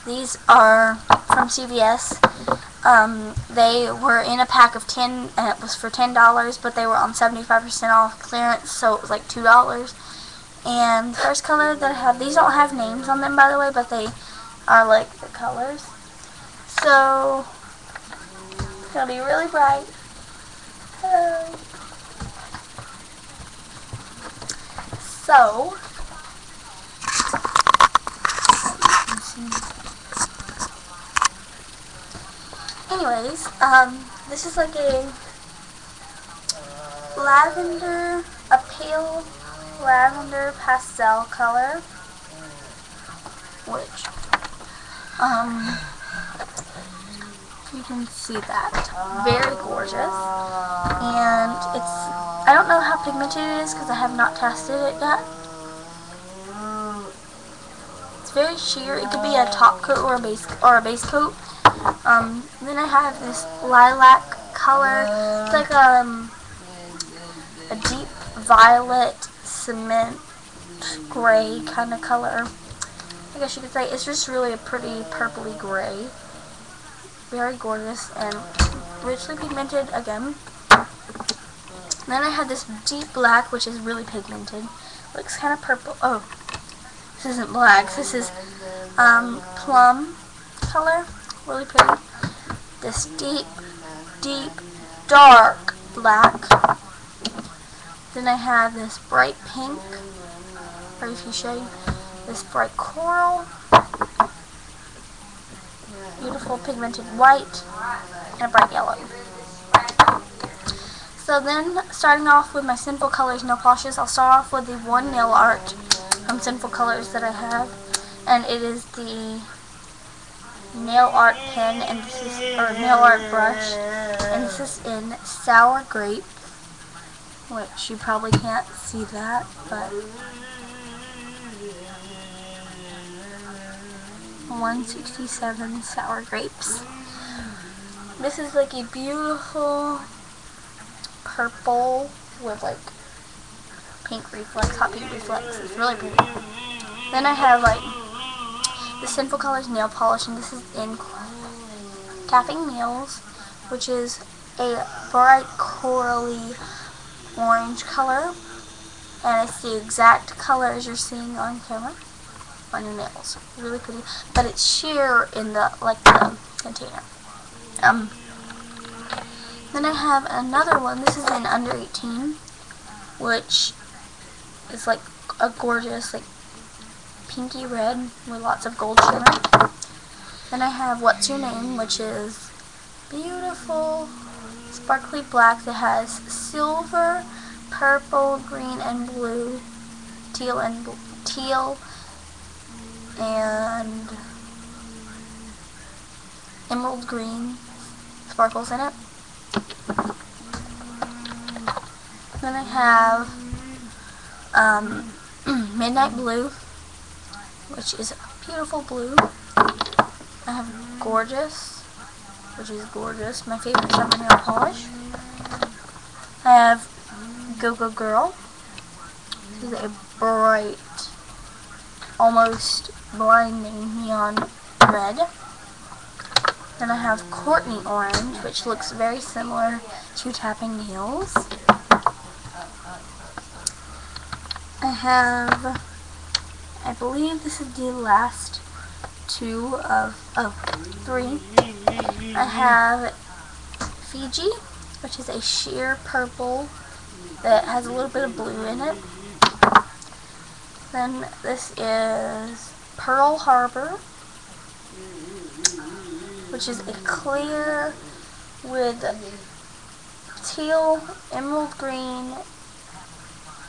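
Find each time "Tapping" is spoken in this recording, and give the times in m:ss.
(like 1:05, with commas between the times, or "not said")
2:32, 3:50.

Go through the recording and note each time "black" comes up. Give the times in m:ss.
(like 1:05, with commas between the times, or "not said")
1:23, 1:27, 1:35, 3:05.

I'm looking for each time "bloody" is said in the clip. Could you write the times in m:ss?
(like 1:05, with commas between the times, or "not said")
not said.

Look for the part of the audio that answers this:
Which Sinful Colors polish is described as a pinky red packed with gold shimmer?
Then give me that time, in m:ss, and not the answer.
2:51.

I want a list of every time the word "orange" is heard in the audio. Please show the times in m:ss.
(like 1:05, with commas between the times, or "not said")
2:37, 3:47.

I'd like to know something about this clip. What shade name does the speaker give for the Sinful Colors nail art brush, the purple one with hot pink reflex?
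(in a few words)
Sour Grape.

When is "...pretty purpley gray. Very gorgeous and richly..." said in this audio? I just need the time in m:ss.
1:14.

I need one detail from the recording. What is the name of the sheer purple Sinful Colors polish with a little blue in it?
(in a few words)
Fiji.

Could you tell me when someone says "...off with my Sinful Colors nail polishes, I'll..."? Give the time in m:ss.
1:52.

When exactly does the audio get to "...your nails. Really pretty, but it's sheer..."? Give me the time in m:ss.
2:42.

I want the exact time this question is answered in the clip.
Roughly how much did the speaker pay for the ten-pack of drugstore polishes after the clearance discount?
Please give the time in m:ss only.
0:09.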